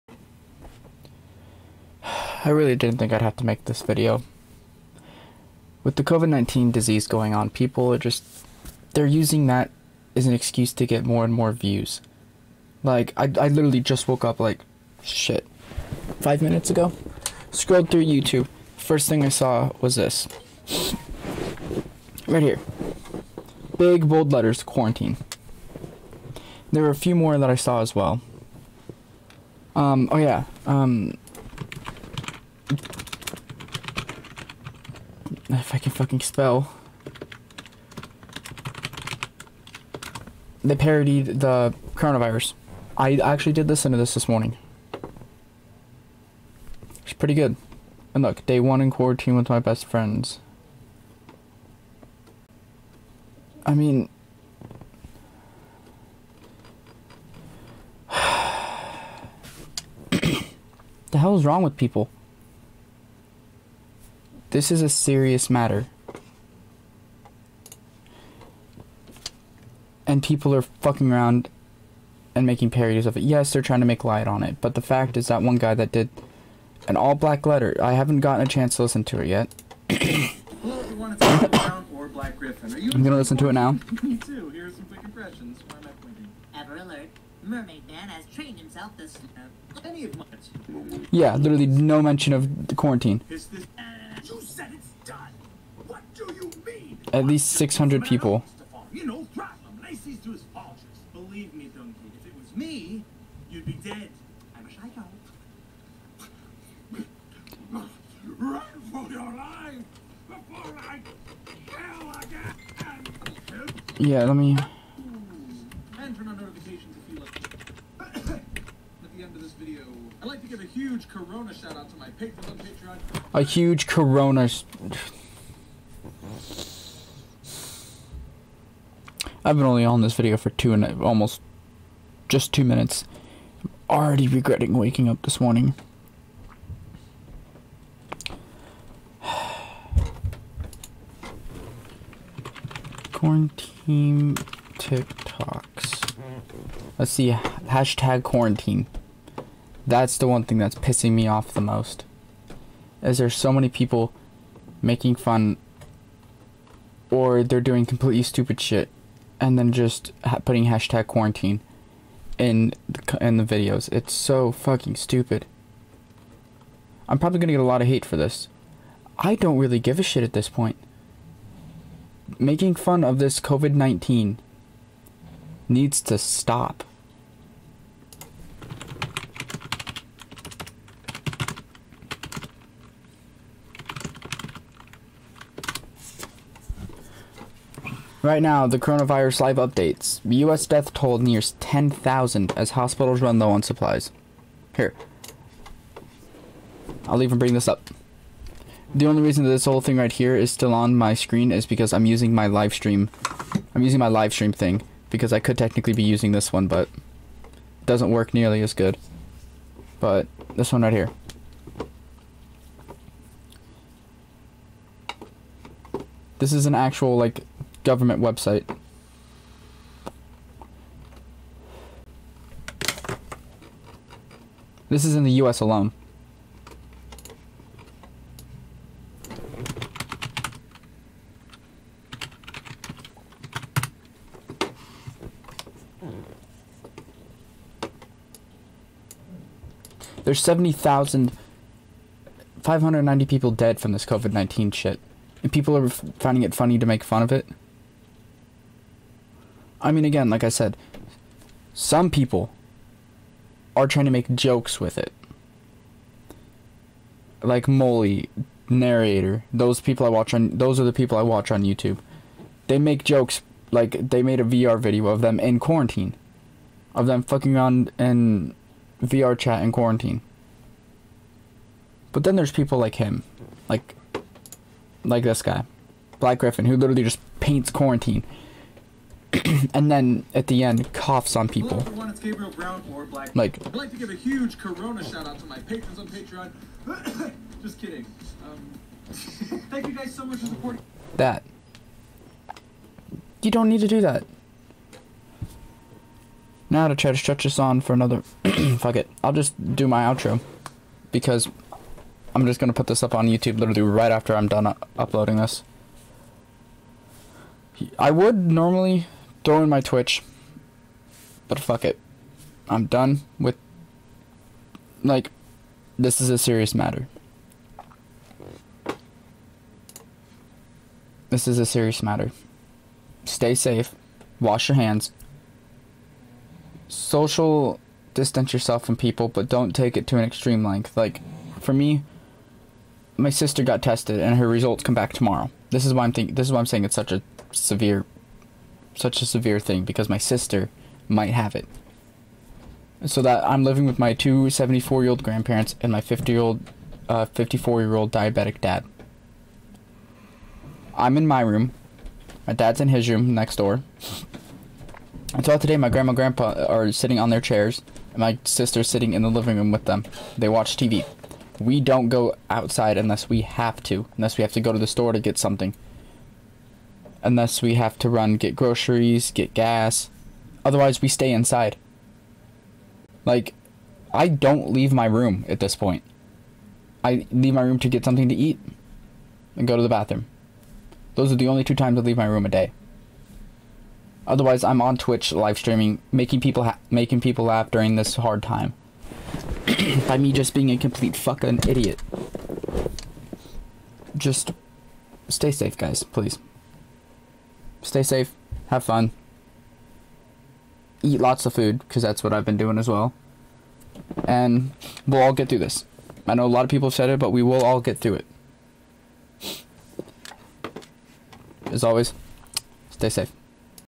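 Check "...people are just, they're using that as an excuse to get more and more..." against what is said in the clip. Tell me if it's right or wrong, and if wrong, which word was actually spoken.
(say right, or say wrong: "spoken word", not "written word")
right.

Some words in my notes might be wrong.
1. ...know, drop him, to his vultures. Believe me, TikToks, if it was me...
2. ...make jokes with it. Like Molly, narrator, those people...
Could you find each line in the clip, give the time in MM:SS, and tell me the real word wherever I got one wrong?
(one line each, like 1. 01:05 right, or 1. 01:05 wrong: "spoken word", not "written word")
1. 01:39 wrong: "Duncan", not "TikToks"
2. 04:14 right.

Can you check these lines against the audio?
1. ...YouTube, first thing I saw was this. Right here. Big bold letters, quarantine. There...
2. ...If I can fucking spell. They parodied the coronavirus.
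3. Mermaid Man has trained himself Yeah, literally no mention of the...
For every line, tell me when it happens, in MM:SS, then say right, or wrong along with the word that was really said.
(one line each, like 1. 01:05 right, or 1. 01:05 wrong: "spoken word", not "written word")
1. 00:18 right
2. 00:35 right
3. 01:27 right.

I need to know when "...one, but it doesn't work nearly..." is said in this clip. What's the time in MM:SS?
03:26.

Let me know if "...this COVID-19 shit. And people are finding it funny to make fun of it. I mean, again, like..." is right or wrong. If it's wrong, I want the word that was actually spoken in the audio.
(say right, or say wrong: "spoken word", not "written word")
right.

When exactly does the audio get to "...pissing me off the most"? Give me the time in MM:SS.
02:30.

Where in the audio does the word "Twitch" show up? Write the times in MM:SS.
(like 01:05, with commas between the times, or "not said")
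05:09, 06:24.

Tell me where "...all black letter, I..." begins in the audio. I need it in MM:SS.
01:16.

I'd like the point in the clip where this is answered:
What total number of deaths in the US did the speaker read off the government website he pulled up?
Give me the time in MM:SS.
04:00.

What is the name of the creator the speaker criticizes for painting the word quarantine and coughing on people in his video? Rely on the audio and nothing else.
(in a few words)
Black Griffin.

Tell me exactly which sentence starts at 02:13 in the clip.
I'm already regretting waking up this morning.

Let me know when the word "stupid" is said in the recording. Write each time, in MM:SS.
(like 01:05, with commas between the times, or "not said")
02:38, 02:44.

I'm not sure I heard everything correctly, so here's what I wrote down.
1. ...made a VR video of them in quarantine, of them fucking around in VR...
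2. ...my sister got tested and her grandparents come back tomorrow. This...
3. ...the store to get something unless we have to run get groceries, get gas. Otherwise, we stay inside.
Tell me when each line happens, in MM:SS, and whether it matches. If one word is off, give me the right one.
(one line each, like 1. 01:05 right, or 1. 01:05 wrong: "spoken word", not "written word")
1. 04:24 right
2. 05:33 wrong: "results", not "grandparents"
3. 06:04 right.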